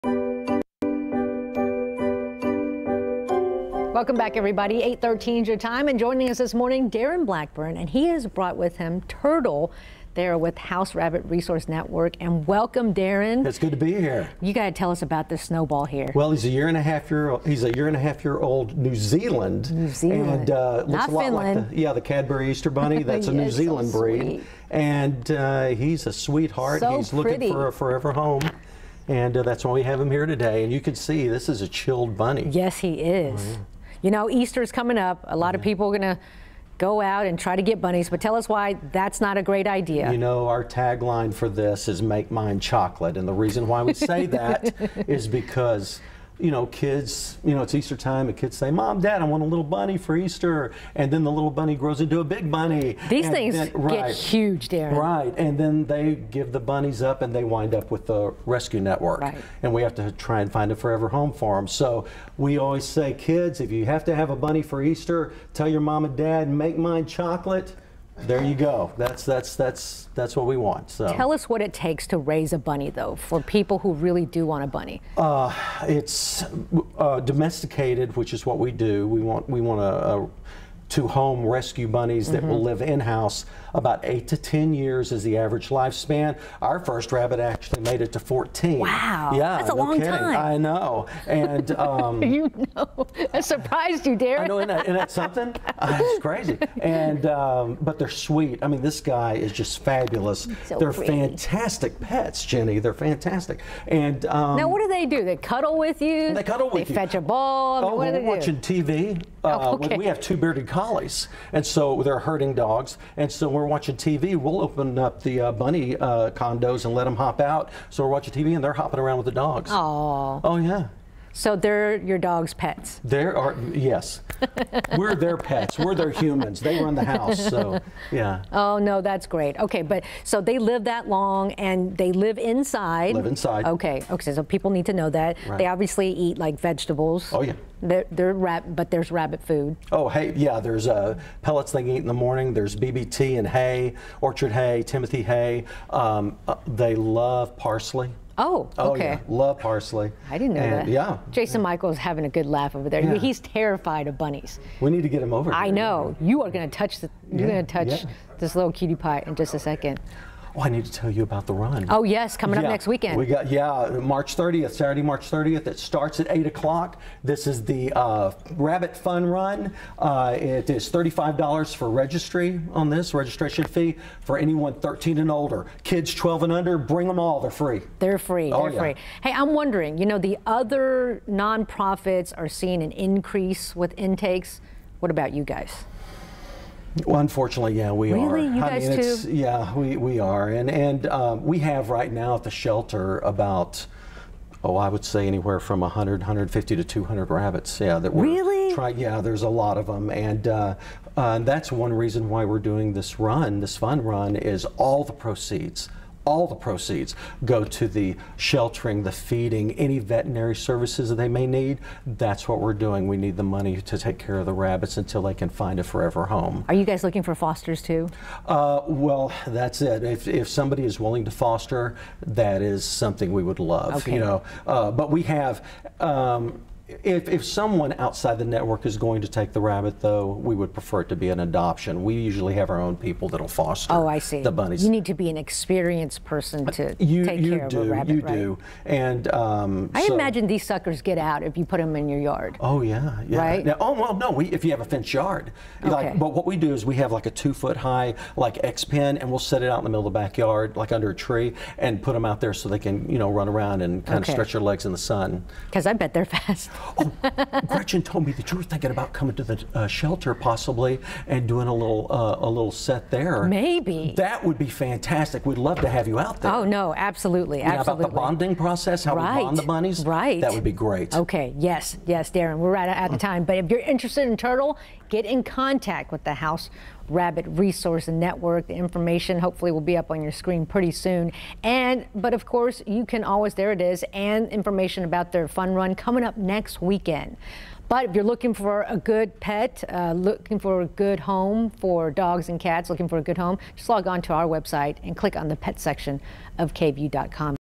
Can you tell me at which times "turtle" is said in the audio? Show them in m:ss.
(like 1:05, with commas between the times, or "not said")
0:09, 4:34.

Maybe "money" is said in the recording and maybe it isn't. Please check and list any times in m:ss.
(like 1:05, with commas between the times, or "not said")
3:33.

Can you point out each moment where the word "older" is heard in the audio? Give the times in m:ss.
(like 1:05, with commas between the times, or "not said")
2:55.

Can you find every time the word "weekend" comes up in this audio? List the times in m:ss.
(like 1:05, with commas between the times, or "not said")
2:42, 4:46.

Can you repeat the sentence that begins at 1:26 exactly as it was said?
Our first rabbit actually made it to 14.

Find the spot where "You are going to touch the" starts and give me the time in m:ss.
2:36.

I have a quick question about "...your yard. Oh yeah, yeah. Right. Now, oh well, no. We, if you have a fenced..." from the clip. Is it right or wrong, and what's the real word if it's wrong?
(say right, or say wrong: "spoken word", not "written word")
right.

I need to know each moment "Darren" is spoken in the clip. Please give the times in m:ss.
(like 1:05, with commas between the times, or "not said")
0:06, 0:12, 0:54, 1:34, 4:32.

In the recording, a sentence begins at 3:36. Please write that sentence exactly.
Are you guys looking for fosters too?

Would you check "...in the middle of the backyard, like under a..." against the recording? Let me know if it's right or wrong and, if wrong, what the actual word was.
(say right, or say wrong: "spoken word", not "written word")
right.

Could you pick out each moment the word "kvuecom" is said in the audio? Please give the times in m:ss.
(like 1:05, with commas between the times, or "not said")
4:56.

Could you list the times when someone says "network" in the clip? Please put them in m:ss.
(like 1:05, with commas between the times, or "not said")
0:11, 0:58, 3:48, 4:38.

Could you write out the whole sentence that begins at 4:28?
About the bonding process, how right.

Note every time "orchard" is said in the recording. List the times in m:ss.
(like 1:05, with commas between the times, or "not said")
2:24.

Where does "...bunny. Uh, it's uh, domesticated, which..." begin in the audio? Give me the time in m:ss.
1:14.